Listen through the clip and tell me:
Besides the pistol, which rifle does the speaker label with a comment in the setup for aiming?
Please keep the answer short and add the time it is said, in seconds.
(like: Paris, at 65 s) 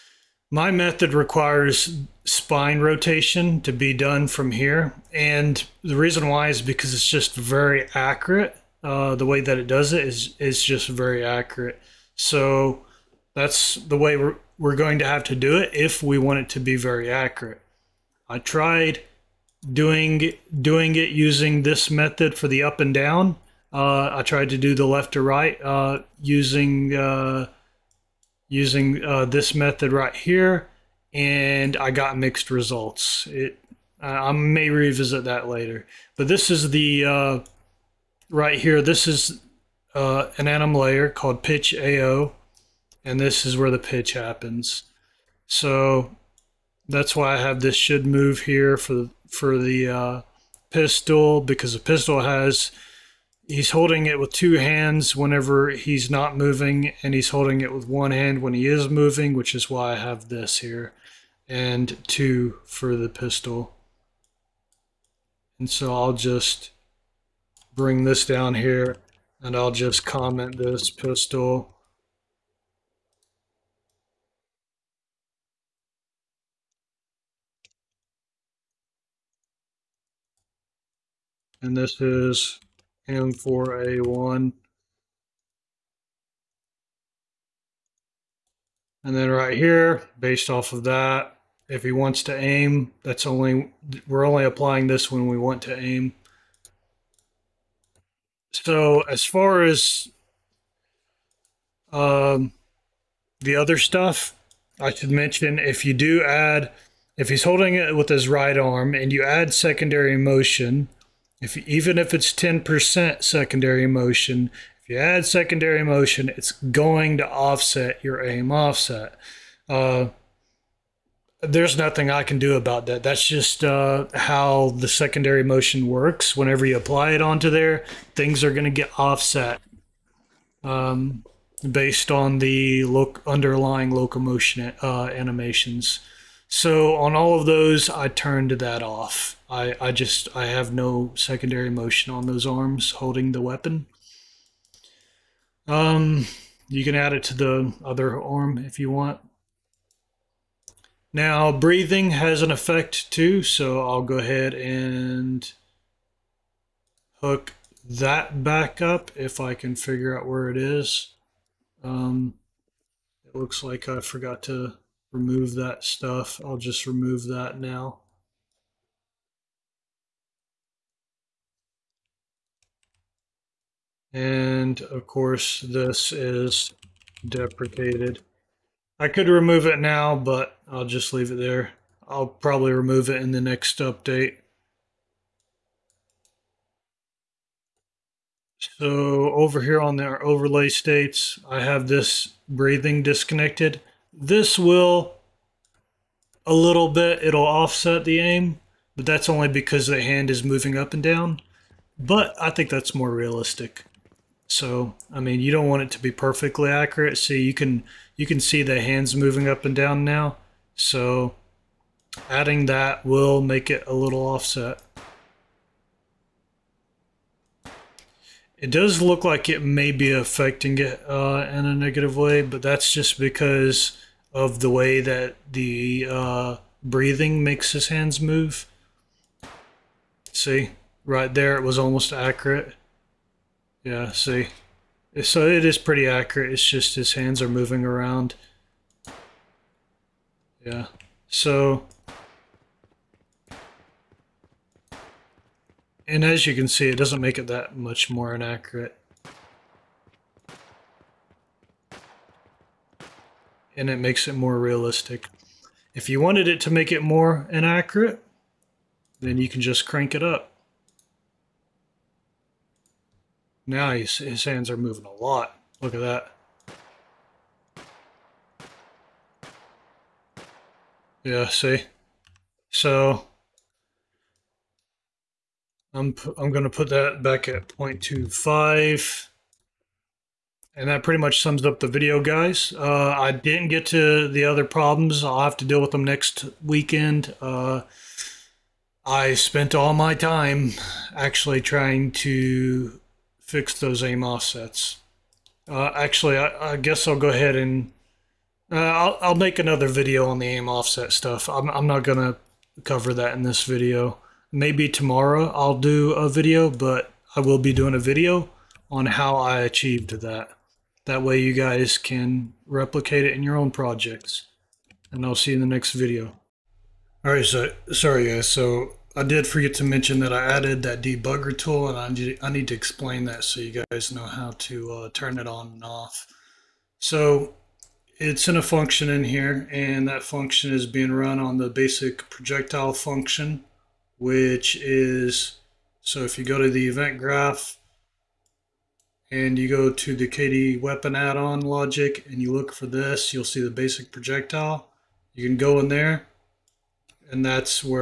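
M4A1, at 83 s.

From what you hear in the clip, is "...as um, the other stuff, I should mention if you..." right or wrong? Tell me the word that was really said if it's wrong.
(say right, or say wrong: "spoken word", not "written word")
right.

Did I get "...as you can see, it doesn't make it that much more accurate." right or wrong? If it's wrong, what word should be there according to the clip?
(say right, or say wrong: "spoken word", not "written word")
wrong: "inaccurate", not "accurate".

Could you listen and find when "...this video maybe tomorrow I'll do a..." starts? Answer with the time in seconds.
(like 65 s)
303 s.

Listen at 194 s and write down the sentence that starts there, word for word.
This will a little bit, it'll offset the aim, but that's only because the hand is moving up and down.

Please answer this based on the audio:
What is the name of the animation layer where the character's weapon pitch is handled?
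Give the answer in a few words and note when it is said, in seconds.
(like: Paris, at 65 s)
pitch AO, at 41 s.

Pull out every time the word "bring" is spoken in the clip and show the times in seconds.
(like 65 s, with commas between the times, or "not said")
67 s.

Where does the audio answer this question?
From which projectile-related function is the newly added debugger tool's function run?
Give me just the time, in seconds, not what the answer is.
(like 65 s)
331 s.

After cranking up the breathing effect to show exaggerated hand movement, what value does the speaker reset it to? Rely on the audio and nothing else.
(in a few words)
0.25.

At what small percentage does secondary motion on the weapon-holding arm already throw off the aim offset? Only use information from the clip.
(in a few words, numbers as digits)
10%.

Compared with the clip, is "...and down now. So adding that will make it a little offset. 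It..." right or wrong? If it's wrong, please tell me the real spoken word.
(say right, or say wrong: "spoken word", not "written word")
right.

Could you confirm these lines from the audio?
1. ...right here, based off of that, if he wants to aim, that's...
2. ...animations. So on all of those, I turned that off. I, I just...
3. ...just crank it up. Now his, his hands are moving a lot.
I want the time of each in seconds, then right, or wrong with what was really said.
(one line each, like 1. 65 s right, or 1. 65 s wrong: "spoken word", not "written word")
1. 89 s right
2. 135 s right
3. 259 s right.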